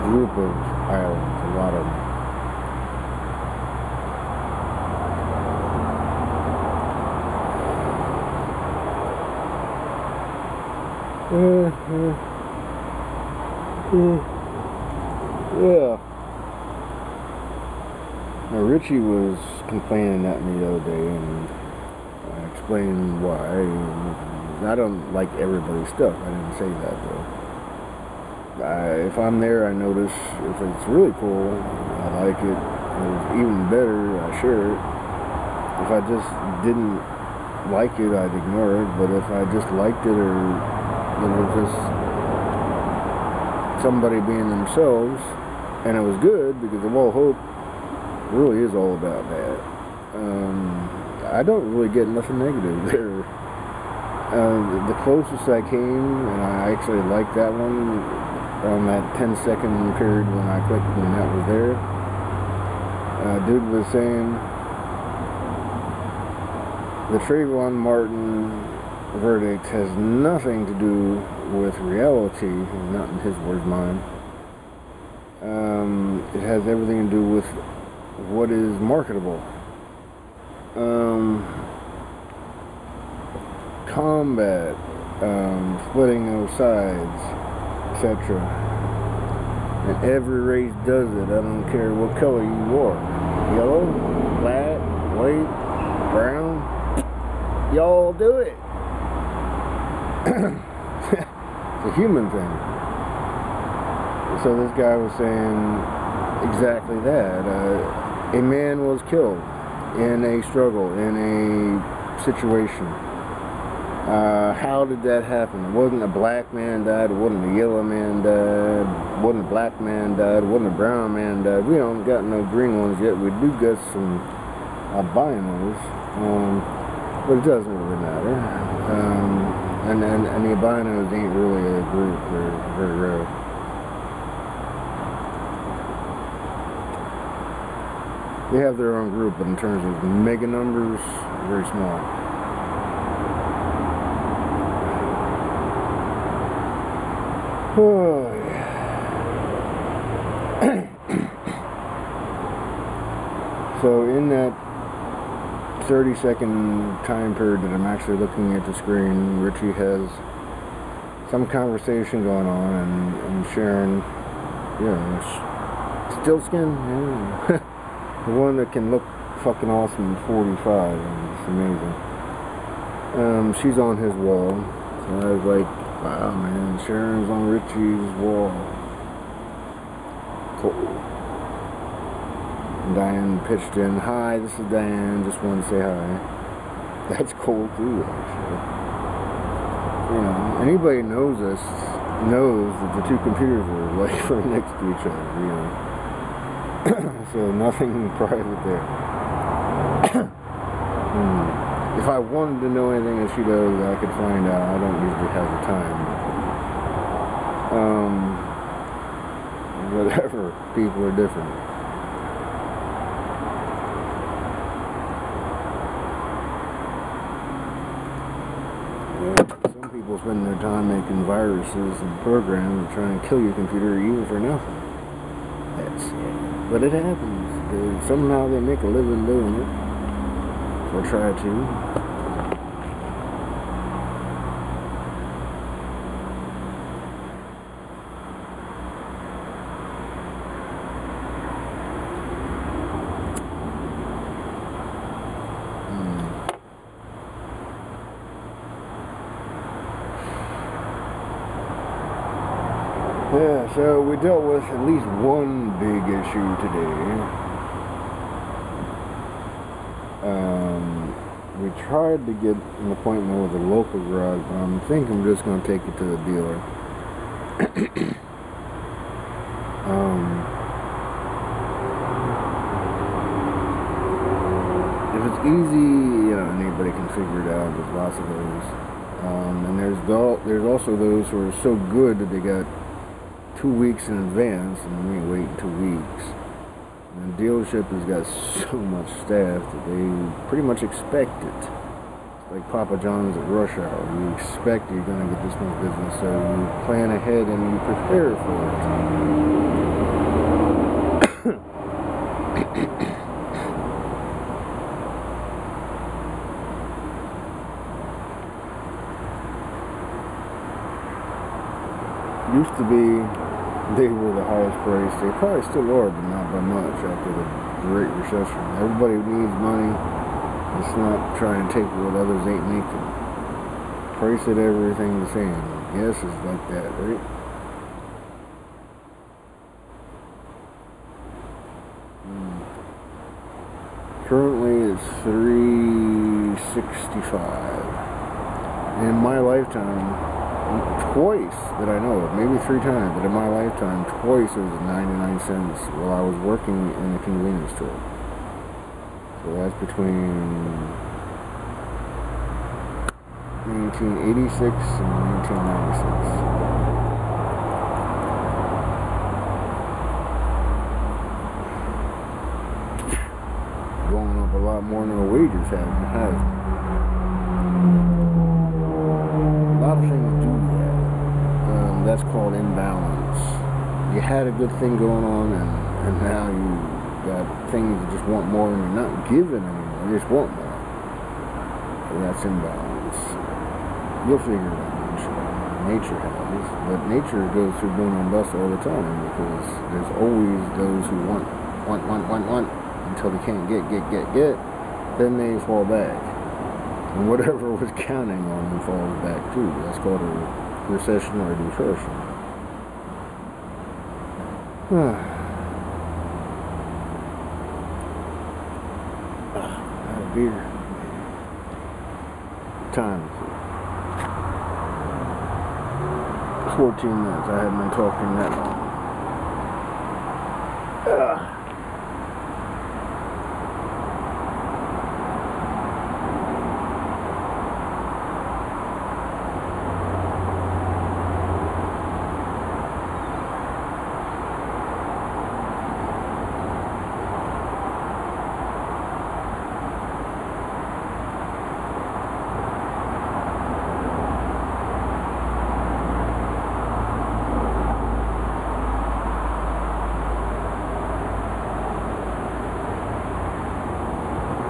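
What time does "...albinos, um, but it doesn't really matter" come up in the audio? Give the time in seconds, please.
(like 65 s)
124 s.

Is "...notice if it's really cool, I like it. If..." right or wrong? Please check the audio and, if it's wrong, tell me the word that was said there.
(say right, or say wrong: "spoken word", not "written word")
right.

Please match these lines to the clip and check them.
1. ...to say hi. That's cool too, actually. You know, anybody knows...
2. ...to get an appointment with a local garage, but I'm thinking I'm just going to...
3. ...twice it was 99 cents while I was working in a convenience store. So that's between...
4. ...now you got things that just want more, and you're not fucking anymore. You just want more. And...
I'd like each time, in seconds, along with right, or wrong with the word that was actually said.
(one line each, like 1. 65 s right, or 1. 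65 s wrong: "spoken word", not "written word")
1. 185 s right
2. 262 s right
3. 344 s right
4. 376 s wrong: "giving", not "fucking".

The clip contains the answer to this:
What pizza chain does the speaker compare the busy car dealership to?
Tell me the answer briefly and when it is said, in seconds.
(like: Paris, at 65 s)
Papa John's, at 292 s.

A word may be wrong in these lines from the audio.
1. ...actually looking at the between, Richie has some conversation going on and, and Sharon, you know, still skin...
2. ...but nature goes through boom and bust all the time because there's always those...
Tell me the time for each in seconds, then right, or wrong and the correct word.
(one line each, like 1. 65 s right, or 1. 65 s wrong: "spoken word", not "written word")
1. 157 s wrong: "screen", not "between"
2. 386 s right.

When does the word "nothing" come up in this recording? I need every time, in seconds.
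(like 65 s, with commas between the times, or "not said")
52 s, 69 s, 197 s, 224 s.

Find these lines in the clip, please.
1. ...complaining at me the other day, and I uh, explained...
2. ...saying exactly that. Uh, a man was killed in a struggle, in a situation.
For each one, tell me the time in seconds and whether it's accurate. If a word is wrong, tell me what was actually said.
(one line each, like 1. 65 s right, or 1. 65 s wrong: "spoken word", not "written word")
1. 19 s right
2. 105 s right.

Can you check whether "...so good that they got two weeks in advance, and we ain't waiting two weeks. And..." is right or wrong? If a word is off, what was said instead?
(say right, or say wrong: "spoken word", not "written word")
right.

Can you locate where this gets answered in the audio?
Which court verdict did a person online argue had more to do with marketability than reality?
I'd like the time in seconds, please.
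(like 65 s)
67 s.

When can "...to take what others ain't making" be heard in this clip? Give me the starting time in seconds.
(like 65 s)
321 s.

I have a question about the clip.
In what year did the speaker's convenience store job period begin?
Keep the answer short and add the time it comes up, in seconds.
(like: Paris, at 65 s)
1986, at 353 s.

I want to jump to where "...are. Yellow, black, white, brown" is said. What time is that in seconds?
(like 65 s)
92 s.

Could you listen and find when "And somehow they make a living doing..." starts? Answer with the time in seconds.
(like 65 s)
227 s.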